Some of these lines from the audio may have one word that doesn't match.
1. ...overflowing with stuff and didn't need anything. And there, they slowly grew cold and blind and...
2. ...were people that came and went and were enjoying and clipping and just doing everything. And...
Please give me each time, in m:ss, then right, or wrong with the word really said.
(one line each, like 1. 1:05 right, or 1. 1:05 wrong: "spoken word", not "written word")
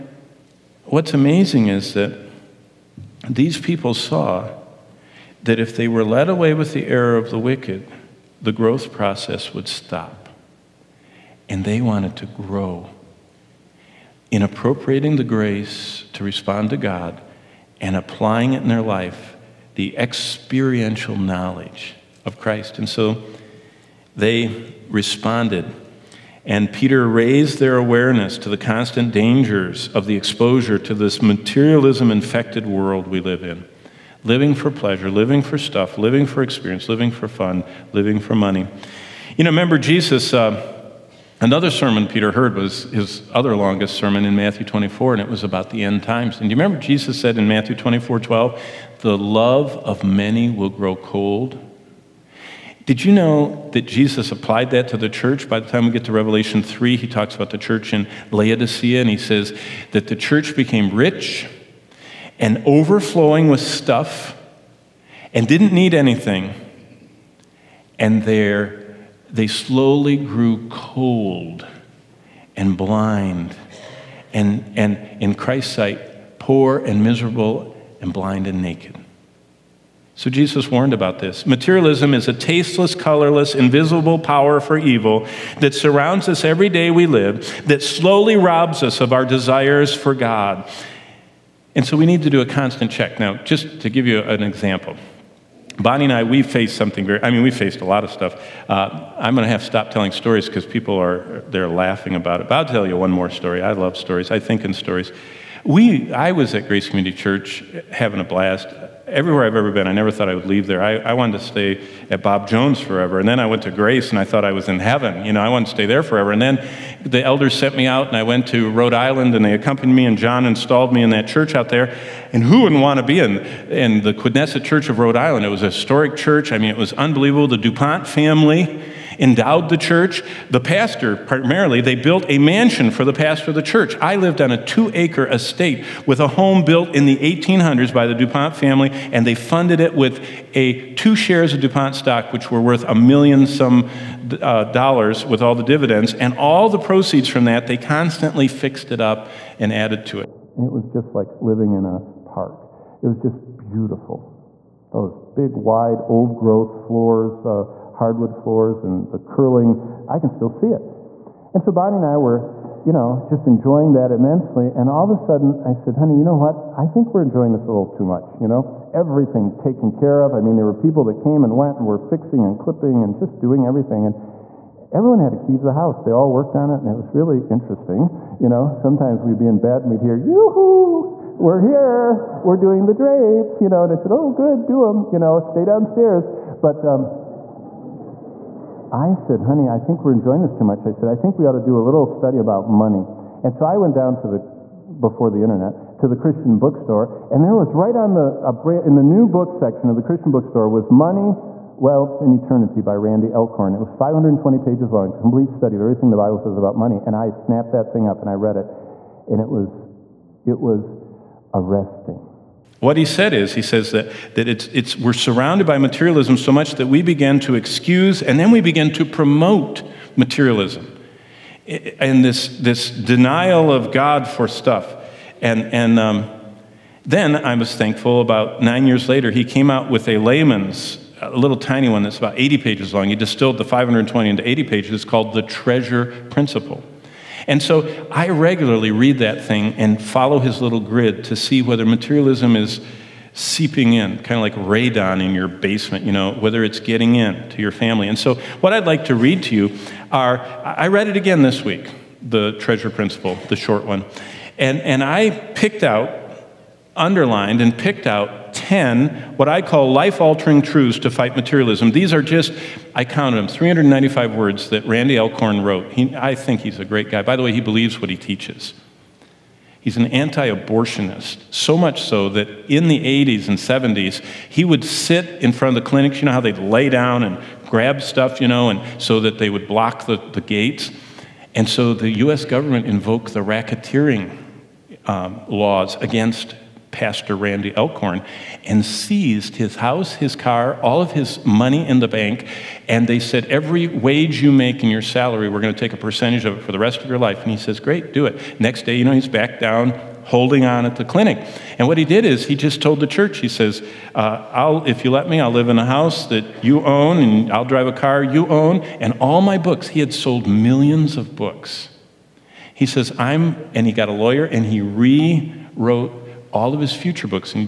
1. 1:02 right
2. 2:50 wrong: "fixing", not "enjoying".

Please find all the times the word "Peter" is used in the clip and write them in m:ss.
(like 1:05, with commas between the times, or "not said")
0:26, 0:42.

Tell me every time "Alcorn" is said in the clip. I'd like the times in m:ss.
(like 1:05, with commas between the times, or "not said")
3:23, 4:25, 4:47.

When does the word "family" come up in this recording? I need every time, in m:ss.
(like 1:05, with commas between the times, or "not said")
2:08, 2:18, 4:07.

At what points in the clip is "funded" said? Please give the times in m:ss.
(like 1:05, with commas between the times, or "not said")
2:19.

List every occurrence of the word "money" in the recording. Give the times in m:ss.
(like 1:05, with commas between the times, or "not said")
0:38, 3:12, 3:20, 3:26, 4:51.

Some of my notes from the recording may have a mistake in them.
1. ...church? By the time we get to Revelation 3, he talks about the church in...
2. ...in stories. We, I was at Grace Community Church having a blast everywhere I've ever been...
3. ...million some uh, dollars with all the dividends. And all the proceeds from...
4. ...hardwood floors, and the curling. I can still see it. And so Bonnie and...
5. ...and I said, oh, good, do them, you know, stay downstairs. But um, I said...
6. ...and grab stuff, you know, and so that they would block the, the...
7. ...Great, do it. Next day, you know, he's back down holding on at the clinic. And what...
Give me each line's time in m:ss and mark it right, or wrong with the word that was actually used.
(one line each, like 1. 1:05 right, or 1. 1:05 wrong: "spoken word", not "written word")
1. 0:55 right
2. 1:44 right
3. 2:22 right
4. 2:37 right
5. 3:03 right
6. 4:37 right
7. 4:57 right.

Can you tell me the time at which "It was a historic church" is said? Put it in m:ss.
2:05.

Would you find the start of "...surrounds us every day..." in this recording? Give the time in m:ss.
1:25.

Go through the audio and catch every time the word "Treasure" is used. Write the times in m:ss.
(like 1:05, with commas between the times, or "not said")
3:55, 4:12.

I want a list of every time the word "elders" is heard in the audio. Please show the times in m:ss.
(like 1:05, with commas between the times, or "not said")
1:57.